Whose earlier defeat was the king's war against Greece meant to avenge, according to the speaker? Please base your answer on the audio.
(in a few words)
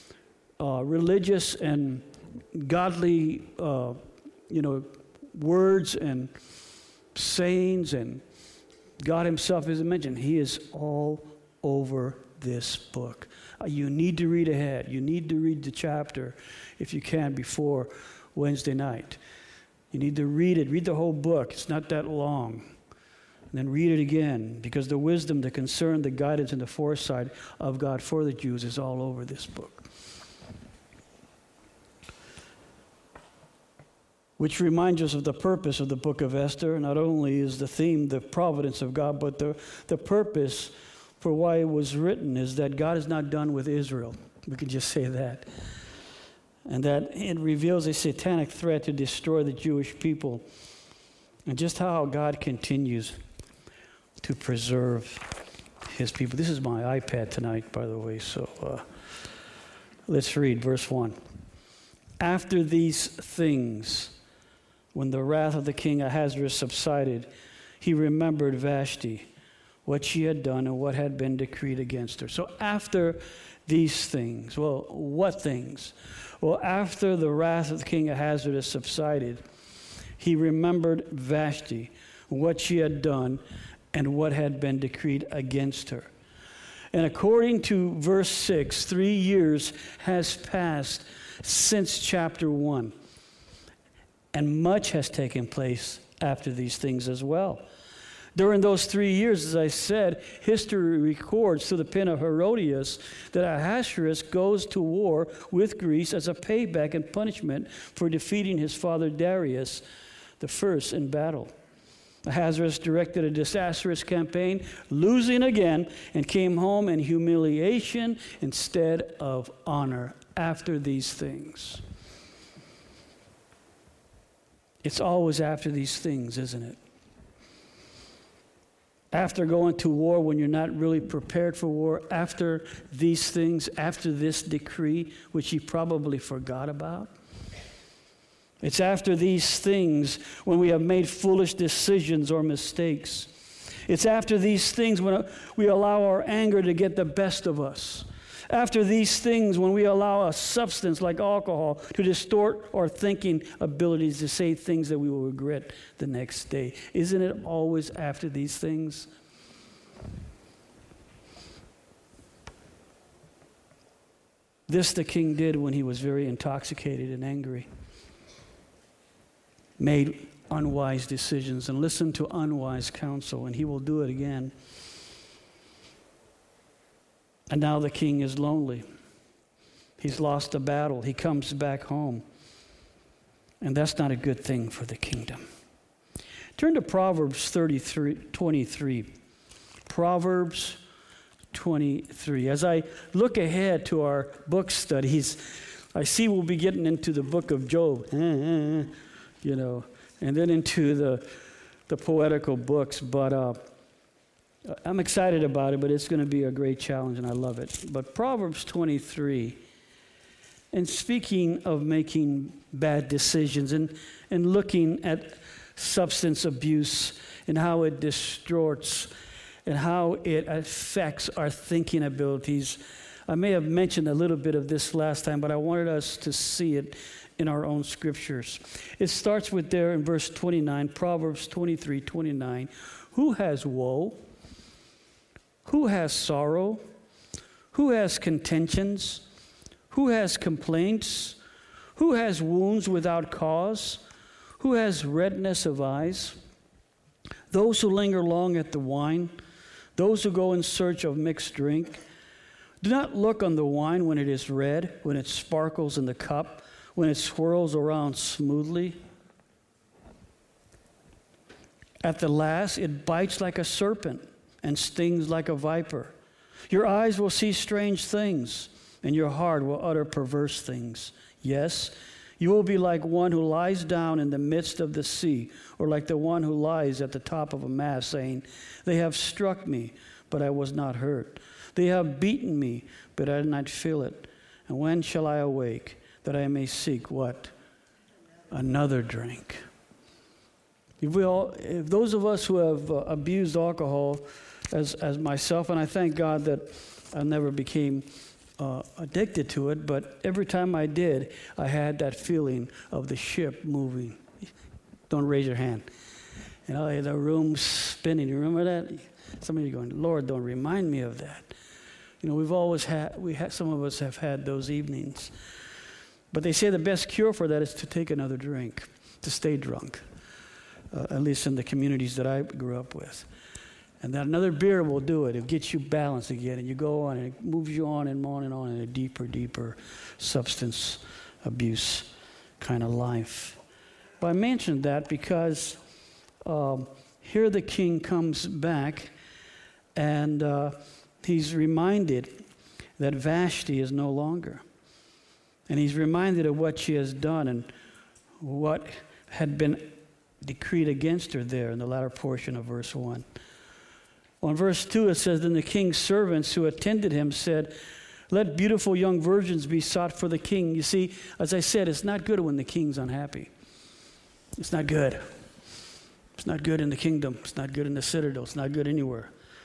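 Darius the first.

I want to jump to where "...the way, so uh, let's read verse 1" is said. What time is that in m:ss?
0:57.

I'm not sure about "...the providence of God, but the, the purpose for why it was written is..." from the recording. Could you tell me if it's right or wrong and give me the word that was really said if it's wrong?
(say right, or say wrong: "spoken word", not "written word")
right.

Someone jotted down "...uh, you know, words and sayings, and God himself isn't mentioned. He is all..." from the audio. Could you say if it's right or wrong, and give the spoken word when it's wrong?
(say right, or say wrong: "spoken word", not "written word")
right.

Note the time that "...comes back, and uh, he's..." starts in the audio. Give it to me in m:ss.
5:37.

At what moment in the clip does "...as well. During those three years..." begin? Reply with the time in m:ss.
1:37.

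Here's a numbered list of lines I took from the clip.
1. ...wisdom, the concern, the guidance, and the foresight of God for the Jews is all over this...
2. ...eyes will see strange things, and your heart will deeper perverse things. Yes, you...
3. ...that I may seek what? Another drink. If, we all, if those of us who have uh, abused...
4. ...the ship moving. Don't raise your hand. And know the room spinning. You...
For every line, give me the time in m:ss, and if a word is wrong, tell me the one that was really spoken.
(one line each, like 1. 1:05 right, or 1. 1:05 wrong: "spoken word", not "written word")
1. 0:24 right
2. 4:26 wrong: "utter", not "deeper"
3. 4:46 right
4. 5:03 right.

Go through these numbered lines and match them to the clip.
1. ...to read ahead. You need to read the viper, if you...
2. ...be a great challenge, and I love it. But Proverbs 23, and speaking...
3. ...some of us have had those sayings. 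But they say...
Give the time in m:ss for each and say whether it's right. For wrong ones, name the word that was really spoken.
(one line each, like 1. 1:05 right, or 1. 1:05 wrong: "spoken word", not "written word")
1. 0:14 wrong: "chapter", not "viper"
2. 3:26 right
3. 5:13 wrong: "evenings", not "sayings".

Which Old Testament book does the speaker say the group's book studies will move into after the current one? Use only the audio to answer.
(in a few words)
Job.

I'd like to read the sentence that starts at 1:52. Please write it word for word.
Ahasuerus directed a disastrous campaign, losing again, and came home in humiliation instead of honor after these things.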